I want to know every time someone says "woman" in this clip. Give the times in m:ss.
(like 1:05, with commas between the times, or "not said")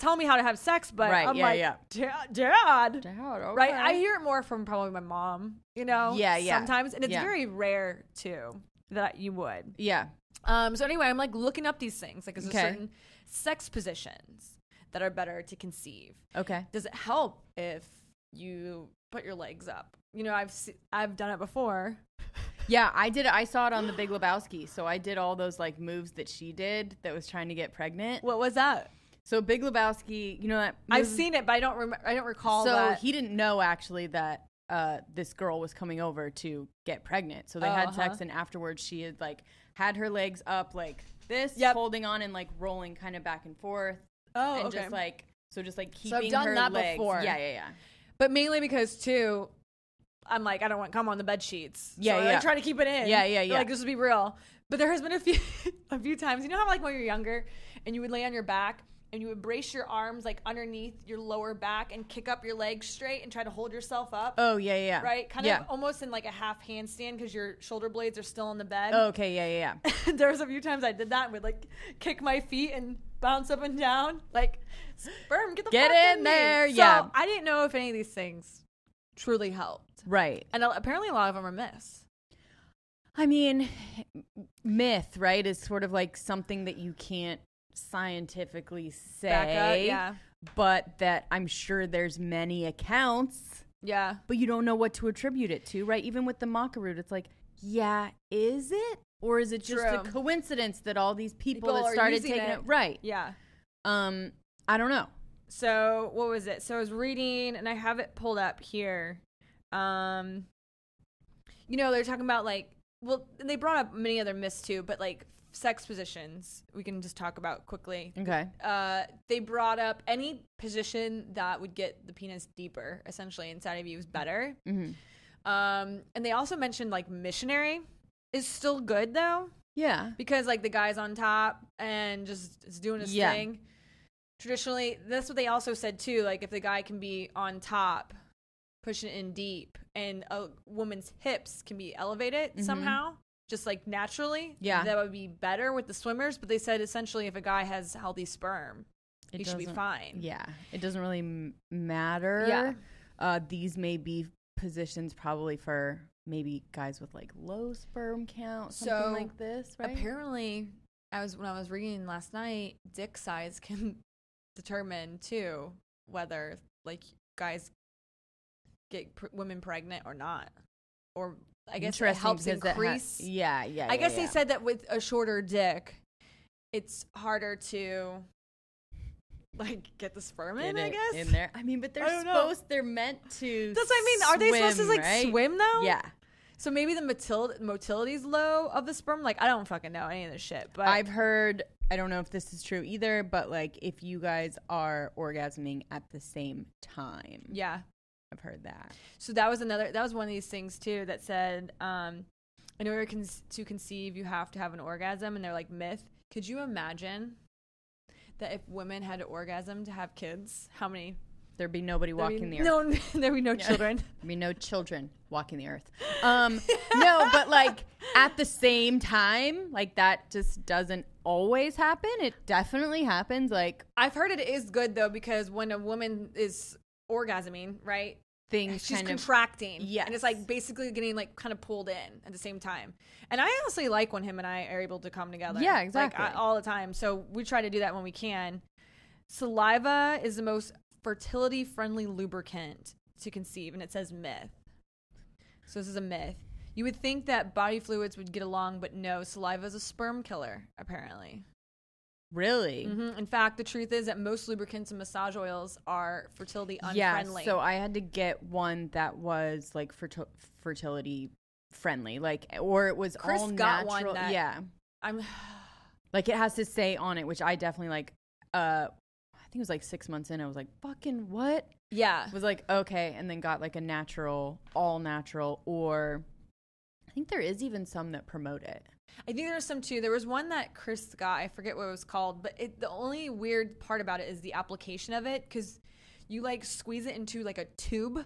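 2:20, 3:45.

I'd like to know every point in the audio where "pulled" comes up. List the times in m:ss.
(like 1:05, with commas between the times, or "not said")
1:48, 3:51.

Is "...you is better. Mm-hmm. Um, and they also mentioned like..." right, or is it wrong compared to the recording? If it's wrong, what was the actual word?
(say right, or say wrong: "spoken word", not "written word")
right.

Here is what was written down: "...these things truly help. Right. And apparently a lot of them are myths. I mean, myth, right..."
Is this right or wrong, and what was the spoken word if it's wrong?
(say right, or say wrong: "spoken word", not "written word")
right.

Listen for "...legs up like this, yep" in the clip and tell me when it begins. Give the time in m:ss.
0:40.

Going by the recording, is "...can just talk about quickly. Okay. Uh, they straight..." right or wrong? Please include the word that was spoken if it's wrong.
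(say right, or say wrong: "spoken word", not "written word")
wrong: "brought", not "straight".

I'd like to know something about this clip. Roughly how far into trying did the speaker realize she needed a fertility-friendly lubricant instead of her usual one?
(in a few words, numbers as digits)
6 months.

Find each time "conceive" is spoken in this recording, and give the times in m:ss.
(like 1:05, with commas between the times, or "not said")
0:15, 3:23, 4:03.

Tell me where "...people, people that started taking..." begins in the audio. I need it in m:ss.
1:41.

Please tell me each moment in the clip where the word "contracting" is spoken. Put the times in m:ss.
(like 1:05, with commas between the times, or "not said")
3:49.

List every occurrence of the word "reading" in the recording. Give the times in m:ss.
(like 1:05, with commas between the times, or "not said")
1:46, 2:41.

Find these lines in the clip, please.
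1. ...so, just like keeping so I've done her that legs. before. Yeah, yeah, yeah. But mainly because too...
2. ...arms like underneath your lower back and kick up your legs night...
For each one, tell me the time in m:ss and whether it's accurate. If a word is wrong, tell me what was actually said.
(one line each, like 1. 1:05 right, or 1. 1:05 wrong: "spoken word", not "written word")
1. 0:45 right
2. 0:59 wrong: "straight", not "night".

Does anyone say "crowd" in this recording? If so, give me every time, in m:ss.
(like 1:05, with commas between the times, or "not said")
not said.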